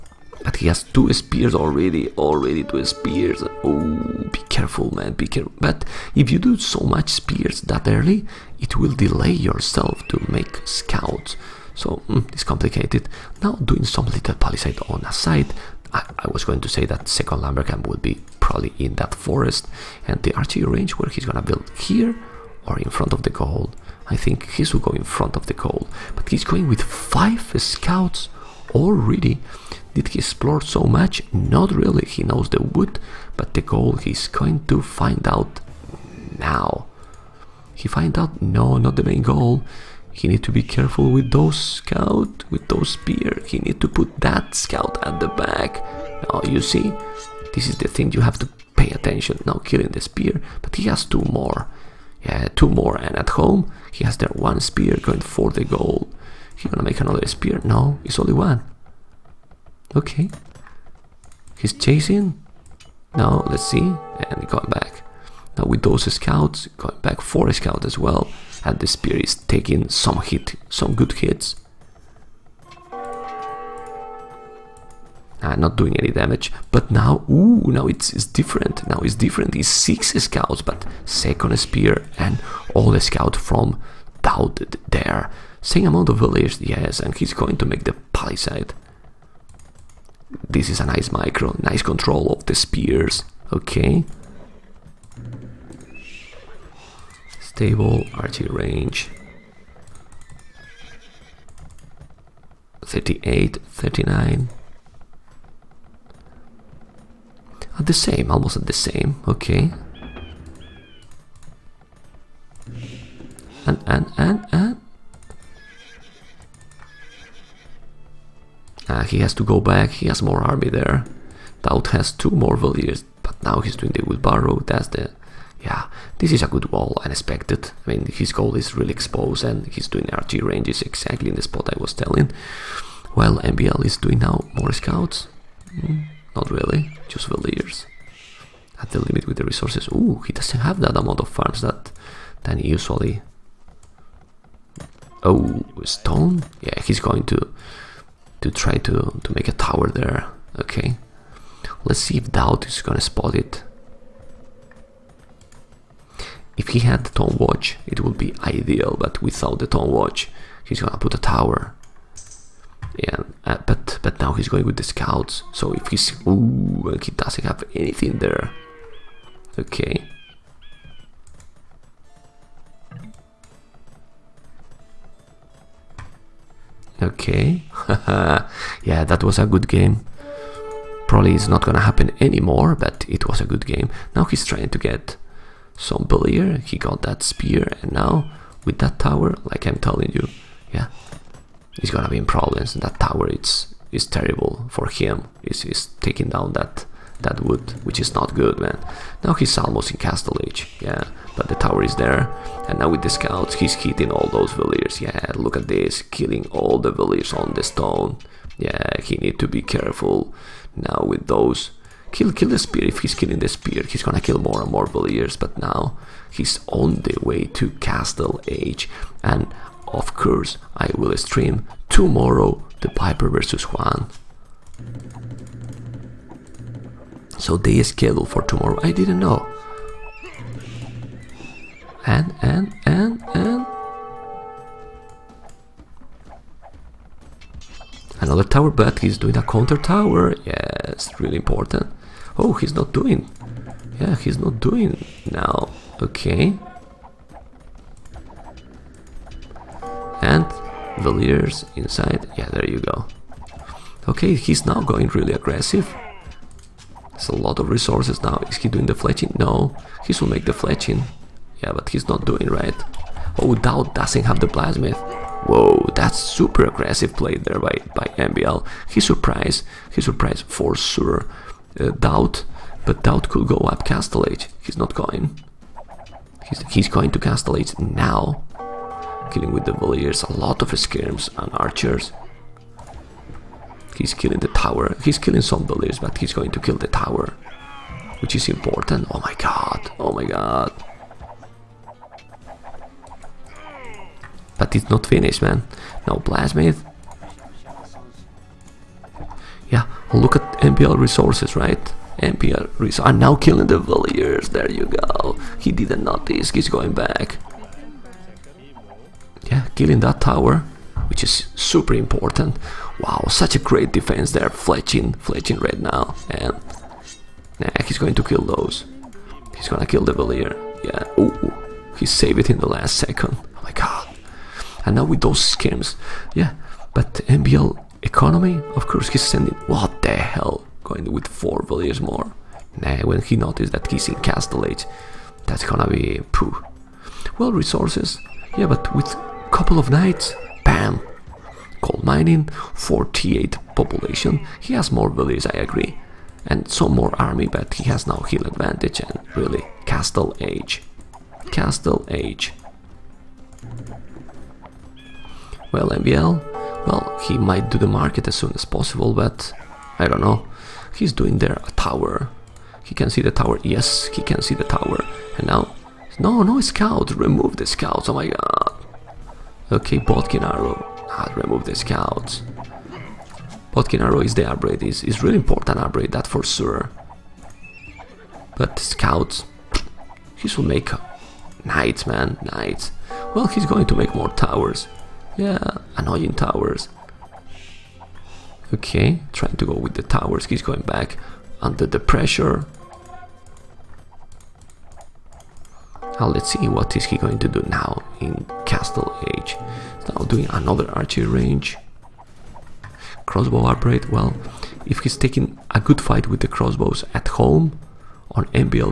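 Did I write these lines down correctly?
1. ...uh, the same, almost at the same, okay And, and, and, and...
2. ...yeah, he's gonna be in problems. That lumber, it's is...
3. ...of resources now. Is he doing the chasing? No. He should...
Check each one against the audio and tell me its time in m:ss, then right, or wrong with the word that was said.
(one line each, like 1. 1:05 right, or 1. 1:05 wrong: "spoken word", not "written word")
1. 1:47 right
2. 3:10 wrong: "tower", not "lumber"
3. 4:17 wrong: "fletching", not "chasing".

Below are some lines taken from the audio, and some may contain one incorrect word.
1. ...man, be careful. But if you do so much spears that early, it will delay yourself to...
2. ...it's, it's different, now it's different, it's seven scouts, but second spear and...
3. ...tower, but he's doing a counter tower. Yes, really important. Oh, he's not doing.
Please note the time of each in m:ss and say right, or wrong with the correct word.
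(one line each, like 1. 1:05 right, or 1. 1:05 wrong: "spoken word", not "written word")
1. 0:04 right
2. 1:17 wrong: "six", not "seven"
3. 3:58 right.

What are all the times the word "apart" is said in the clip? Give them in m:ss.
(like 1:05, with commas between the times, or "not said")
not said.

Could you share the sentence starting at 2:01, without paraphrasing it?
DauT has two more valiers, but now he's doing the wheelbarrow, that's the yeah, this is a good wall, I expected.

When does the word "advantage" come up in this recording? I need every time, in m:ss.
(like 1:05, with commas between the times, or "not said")
5:48.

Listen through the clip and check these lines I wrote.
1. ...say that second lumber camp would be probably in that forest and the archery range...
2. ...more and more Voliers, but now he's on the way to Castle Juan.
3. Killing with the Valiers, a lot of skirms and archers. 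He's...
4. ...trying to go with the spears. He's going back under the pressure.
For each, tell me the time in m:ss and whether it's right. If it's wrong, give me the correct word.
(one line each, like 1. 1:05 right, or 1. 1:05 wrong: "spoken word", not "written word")
1. 0:16 right
2. 3:34 wrong: "Age", not "Juan"
3. 4:39 right
4. 6:29 wrong: "towers", not "spears".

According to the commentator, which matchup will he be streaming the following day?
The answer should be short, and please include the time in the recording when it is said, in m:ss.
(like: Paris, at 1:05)
Piper versus Juan, at 3:42.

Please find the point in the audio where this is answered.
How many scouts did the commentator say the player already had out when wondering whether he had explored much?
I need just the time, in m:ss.
0:26.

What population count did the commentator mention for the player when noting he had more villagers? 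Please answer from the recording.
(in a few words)
48.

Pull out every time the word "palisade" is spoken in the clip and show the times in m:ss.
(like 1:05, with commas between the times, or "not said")
0:14, 1:28.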